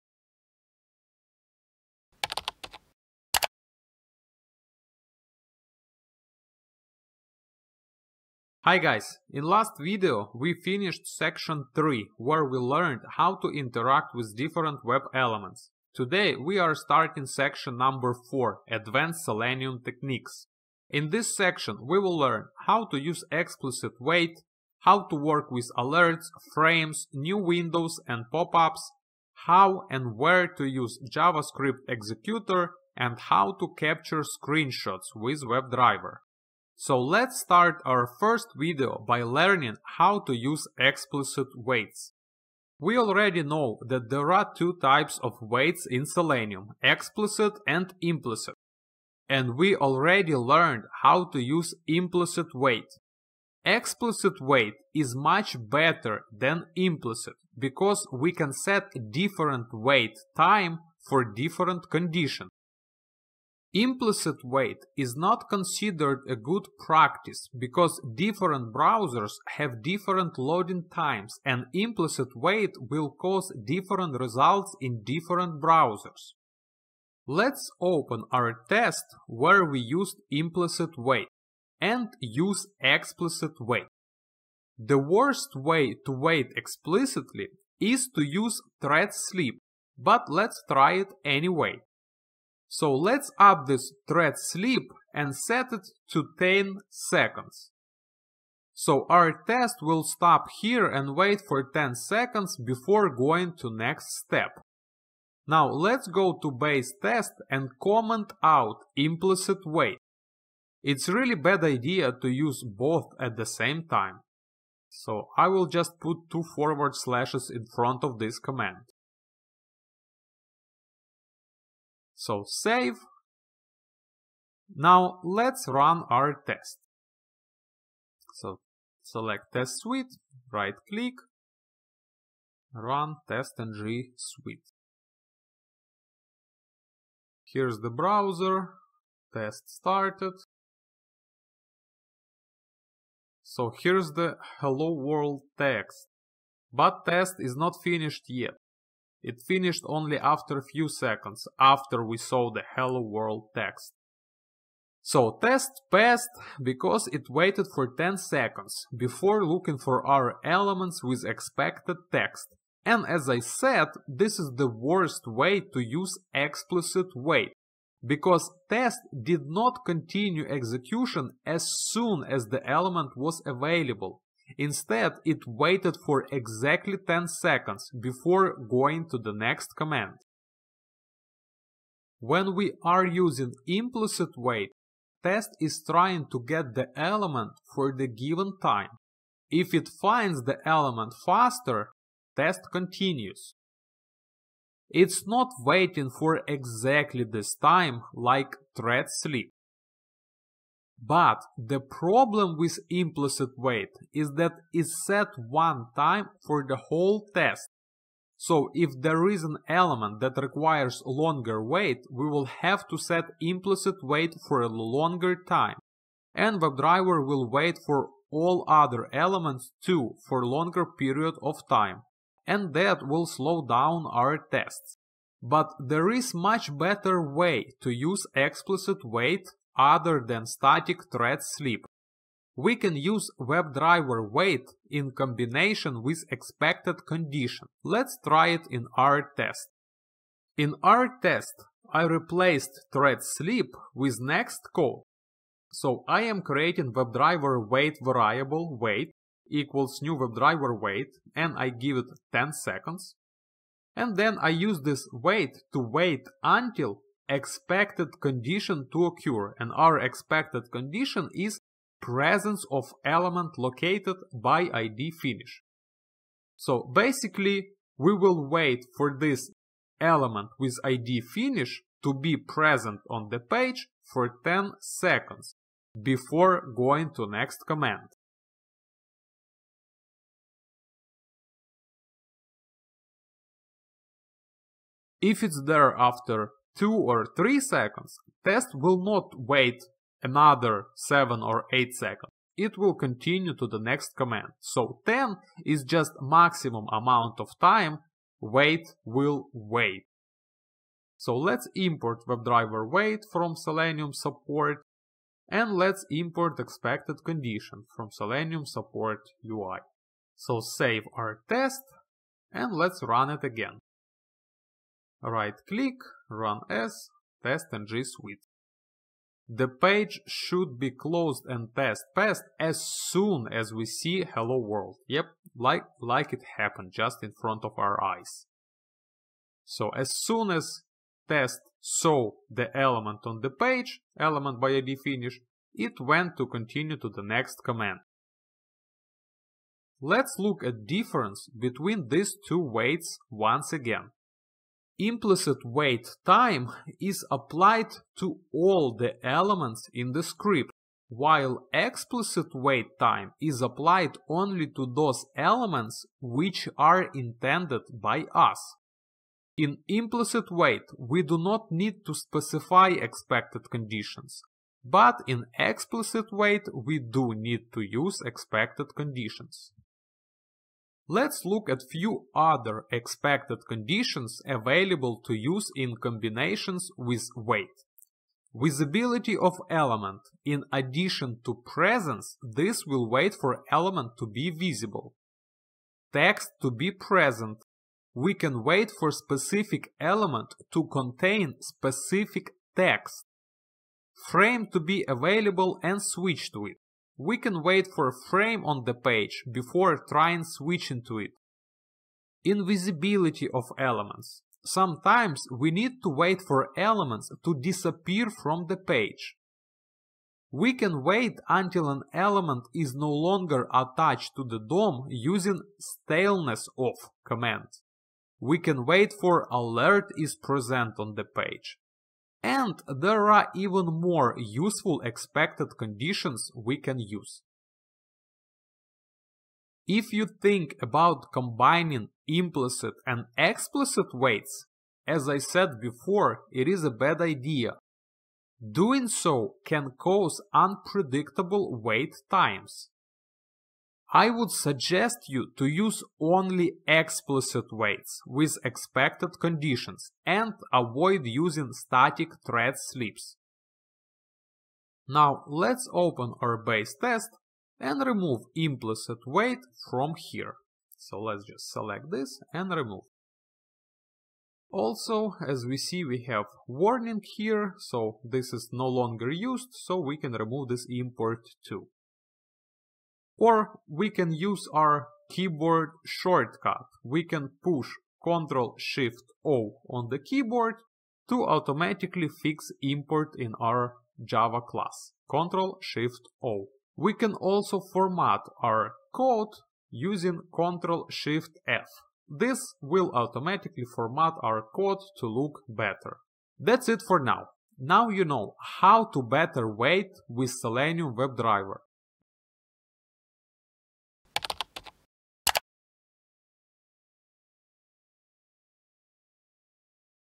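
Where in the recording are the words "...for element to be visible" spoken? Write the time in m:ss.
6:23.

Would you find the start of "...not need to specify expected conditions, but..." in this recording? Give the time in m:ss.
6:01.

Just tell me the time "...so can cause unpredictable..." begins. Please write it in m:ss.
7:19.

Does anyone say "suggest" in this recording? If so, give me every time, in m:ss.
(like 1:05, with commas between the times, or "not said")
7:24.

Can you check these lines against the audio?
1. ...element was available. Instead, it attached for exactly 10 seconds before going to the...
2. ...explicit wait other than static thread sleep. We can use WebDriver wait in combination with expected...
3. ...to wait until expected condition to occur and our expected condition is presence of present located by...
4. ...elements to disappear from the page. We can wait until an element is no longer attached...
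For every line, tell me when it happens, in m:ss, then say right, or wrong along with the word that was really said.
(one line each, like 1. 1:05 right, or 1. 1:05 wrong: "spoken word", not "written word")
1. 2:52 wrong: "waited", not "attached"
2. 3:48 right
3. 4:15 wrong: "element", not "present"
4. 6:46 right.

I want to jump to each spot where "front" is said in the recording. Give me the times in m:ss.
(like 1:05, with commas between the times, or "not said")
1:57, 5:27.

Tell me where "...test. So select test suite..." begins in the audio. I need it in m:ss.
2:06.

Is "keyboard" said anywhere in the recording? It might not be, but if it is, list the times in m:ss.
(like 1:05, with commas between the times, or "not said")
7:55, 8:00.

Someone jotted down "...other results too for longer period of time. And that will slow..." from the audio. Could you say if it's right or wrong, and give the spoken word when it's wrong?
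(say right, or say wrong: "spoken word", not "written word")
wrong: "elements", not "results".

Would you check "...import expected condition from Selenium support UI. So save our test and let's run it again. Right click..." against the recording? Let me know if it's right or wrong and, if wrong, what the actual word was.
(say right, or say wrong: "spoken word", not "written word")
right.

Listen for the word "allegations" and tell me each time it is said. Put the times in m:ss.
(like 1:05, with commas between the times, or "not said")
not said.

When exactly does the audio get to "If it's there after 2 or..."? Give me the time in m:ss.
4:45.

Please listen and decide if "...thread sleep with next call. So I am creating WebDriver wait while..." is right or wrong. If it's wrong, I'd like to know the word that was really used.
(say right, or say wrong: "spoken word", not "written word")
wrong: "variable", not "while".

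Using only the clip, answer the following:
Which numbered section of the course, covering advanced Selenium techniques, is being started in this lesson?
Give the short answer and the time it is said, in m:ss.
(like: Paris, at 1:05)
4, at 0:17.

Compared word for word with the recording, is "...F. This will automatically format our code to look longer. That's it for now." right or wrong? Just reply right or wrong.
wrong.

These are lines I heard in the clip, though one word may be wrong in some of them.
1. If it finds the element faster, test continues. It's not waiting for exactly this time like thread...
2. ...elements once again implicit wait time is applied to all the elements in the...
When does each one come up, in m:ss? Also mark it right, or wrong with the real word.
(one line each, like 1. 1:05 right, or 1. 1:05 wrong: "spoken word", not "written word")
1. 3:09 right
2. 5:42 wrong: "waits", not "elements".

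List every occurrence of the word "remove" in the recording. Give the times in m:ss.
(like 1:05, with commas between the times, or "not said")
7:38, 7:42, 7:50.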